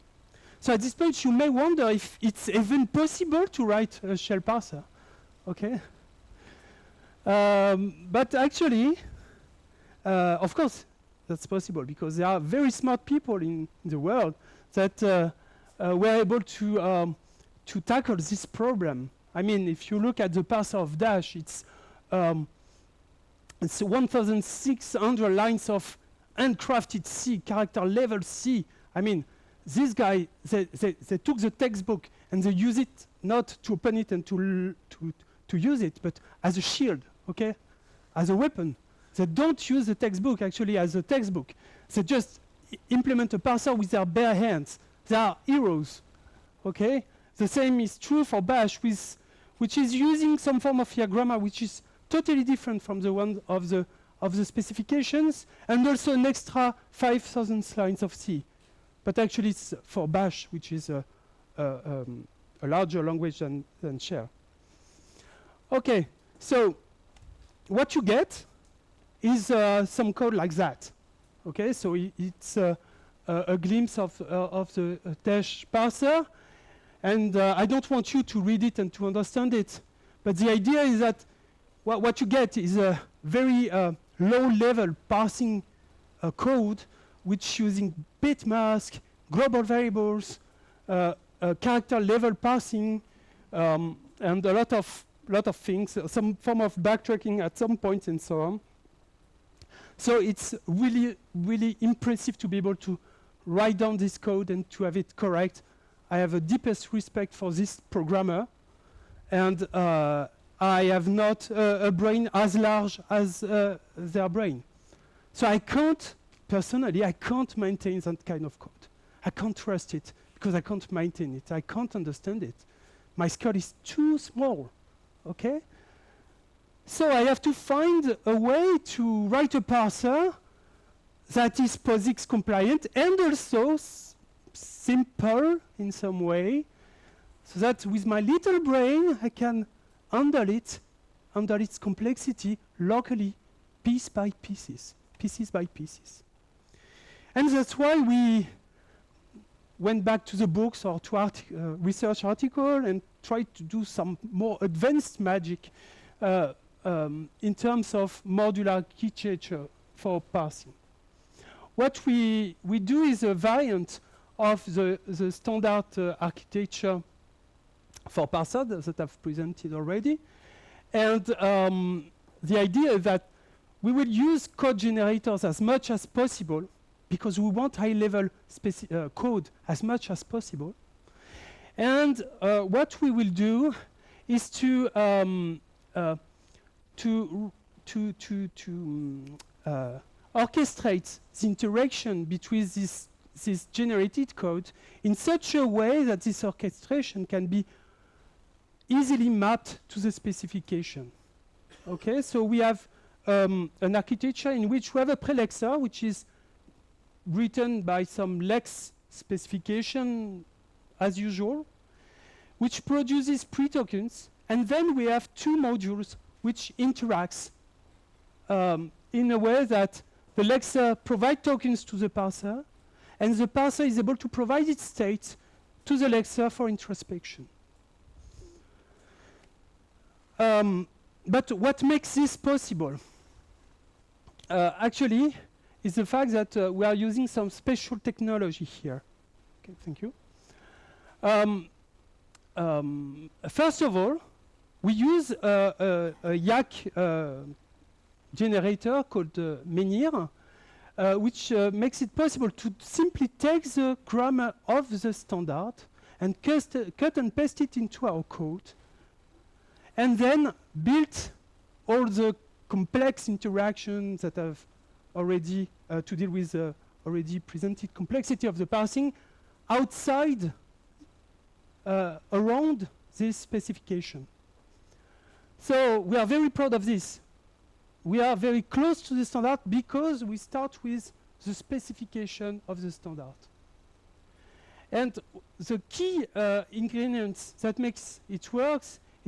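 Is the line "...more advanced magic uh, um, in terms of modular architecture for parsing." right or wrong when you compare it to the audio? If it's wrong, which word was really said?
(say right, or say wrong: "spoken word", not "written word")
right.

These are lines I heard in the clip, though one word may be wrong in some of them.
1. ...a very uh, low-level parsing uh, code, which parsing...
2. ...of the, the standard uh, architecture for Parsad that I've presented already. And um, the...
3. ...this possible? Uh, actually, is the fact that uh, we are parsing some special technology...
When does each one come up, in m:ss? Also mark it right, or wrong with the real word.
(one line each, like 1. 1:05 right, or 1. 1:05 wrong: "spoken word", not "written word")
1. 1:22 wrong: "using", not "parsing"
2. 2:44 right
3. 3:52 wrong: "using", not "parsing".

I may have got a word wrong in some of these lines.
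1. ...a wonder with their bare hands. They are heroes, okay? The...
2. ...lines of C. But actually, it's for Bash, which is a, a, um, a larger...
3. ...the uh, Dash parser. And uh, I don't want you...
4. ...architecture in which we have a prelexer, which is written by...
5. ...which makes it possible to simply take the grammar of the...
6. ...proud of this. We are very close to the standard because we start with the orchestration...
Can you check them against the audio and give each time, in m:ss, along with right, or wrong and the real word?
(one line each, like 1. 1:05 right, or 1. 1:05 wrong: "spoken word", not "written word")
1. 0:43 wrong: "parser", not "wonder"
2. 0:57 right
3. 1:14 right
4. 3:23 right
5. 4:11 right
6. 4:36 wrong: "specification", not "orchestration".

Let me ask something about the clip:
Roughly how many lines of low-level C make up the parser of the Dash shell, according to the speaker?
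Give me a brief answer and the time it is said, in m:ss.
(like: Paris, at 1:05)
1,600, at 0:23.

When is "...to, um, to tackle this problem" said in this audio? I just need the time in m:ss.
0:16.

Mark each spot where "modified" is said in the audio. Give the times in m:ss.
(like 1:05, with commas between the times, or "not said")
not said.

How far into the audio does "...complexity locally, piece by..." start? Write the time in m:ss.
2:21.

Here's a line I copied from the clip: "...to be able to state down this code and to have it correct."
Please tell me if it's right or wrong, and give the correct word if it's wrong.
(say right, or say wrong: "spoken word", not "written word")
wrong: "write", not "state".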